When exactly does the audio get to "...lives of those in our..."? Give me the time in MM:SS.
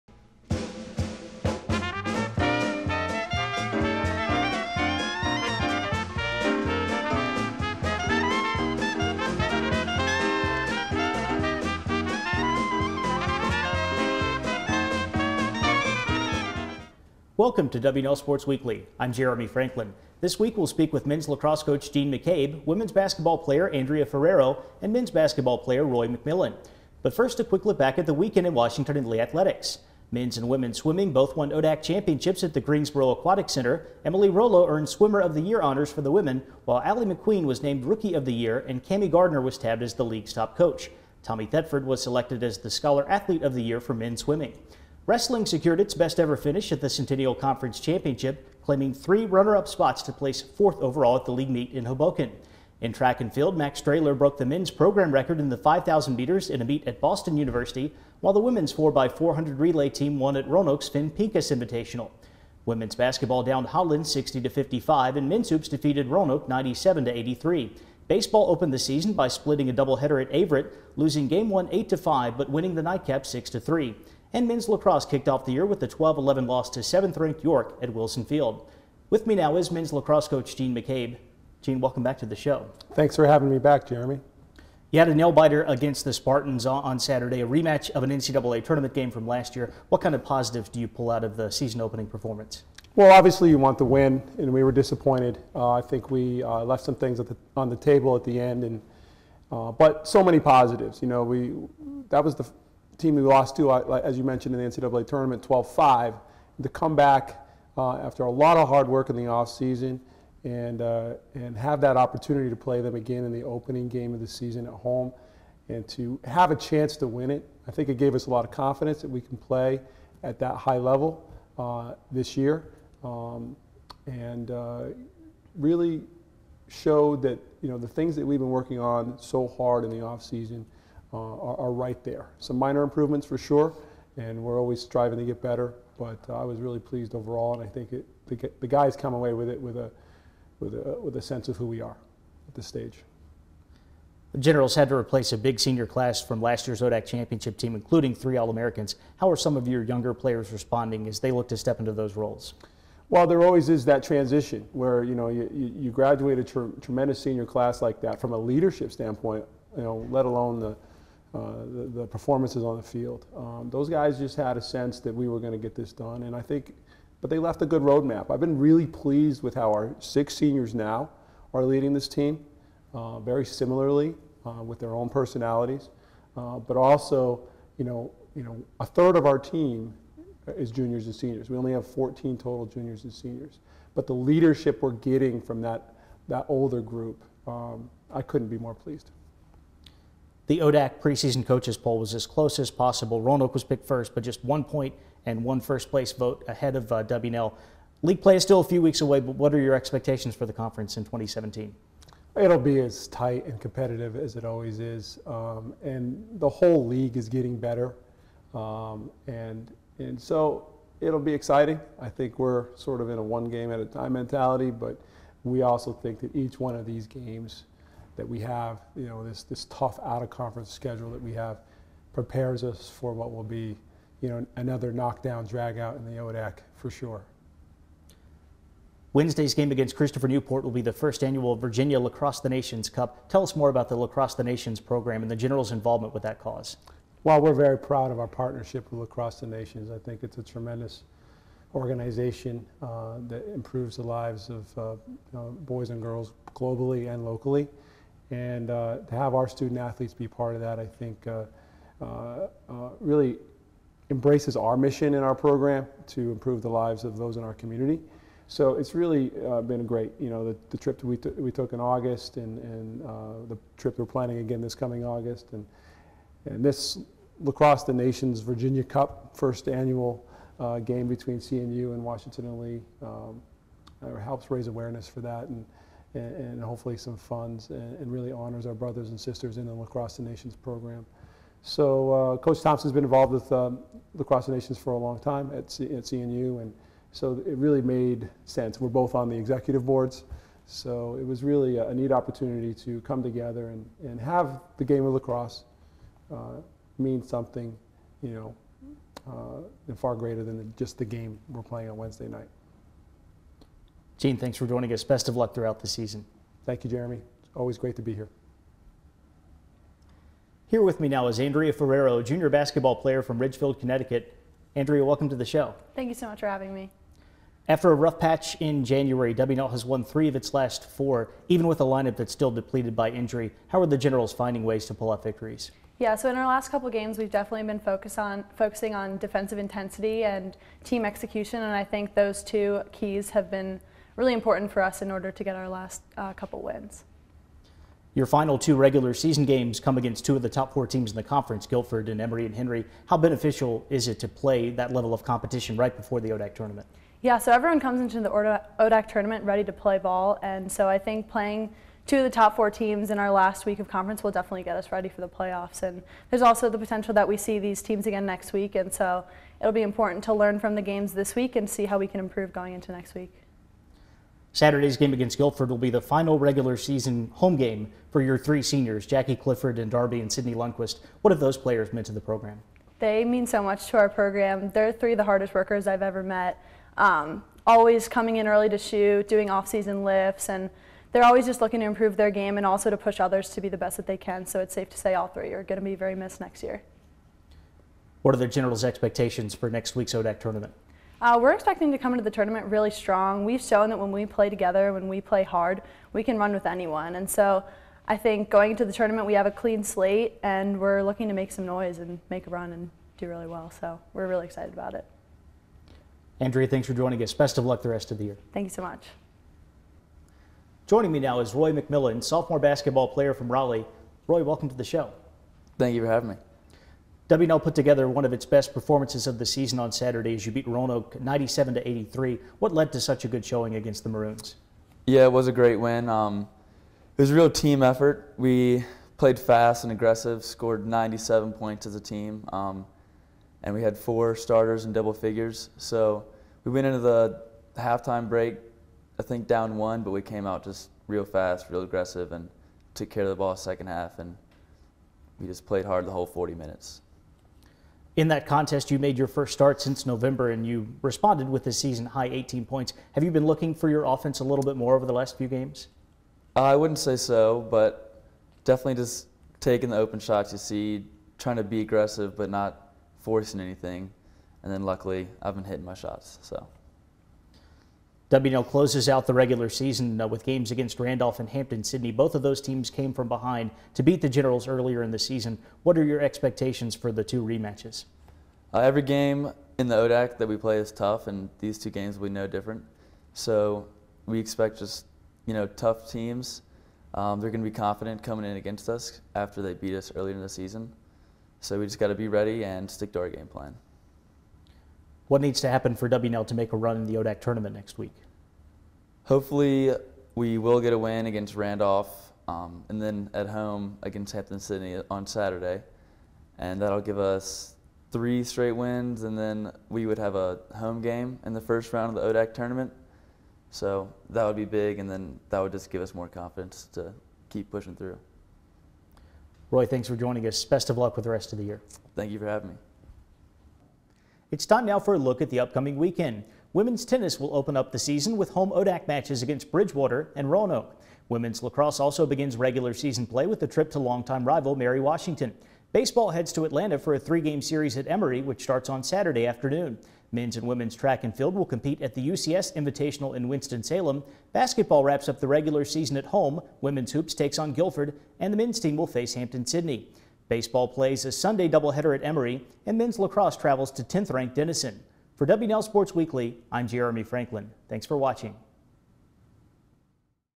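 04:16.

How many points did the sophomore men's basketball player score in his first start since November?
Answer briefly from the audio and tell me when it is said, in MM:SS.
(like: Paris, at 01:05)
18, at 07:32.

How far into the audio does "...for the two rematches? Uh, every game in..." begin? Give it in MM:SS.
07:56.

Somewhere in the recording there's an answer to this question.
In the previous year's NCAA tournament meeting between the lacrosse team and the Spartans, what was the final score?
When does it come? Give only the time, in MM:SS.
01:45.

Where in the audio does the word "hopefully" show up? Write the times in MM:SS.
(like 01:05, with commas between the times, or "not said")
04:36, 08:19.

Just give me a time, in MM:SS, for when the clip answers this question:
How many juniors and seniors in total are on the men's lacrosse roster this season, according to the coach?
03:01.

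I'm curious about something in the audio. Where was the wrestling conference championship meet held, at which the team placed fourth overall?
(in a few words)
Hoboken.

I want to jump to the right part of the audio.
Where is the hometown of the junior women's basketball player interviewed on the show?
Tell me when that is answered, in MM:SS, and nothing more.
05:13.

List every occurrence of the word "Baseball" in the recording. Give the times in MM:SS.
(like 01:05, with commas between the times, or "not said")
01:08, 08:55, 09:10.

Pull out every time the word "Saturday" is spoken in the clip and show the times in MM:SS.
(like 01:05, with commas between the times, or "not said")
01:26, 06:04, 06:59, 08:25, 08:59.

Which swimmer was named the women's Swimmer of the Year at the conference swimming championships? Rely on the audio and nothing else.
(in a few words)
Emily Rollo.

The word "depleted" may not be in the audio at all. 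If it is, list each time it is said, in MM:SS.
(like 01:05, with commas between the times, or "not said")
05:22.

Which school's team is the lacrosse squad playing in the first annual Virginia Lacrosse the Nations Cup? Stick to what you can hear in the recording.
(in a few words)
Christopher Newport.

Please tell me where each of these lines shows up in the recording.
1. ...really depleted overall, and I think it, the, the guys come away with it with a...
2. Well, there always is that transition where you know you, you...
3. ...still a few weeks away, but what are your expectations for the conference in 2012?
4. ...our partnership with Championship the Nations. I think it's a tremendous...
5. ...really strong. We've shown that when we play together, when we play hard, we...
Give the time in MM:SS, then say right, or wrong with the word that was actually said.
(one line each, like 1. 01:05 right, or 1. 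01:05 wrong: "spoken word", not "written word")
1. 02:16 wrong: "pleased", not "depleted"
2. 02:33 right
3. 03:18 wrong: "2017", not "2012"
4. 03:58 wrong: "Lacrosse", not "Championship"
5. 06:32 right.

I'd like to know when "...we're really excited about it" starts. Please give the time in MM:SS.
06:44.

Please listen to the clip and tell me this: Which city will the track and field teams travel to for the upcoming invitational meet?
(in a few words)
Winston-Salem.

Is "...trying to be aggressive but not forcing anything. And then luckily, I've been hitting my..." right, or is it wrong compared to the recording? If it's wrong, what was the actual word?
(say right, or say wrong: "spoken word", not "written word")
right.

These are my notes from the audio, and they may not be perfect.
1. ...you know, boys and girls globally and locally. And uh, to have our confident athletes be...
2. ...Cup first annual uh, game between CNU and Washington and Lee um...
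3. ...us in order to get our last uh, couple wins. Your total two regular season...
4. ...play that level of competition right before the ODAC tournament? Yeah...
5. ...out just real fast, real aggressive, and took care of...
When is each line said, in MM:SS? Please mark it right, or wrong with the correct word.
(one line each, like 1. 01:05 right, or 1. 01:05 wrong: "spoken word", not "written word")
1. 04:05 wrong: "student", not "confident"
2. 04:28 right
3. 05:34 wrong: "final", not "total"
4. 05:44 right
5. 07:20 right.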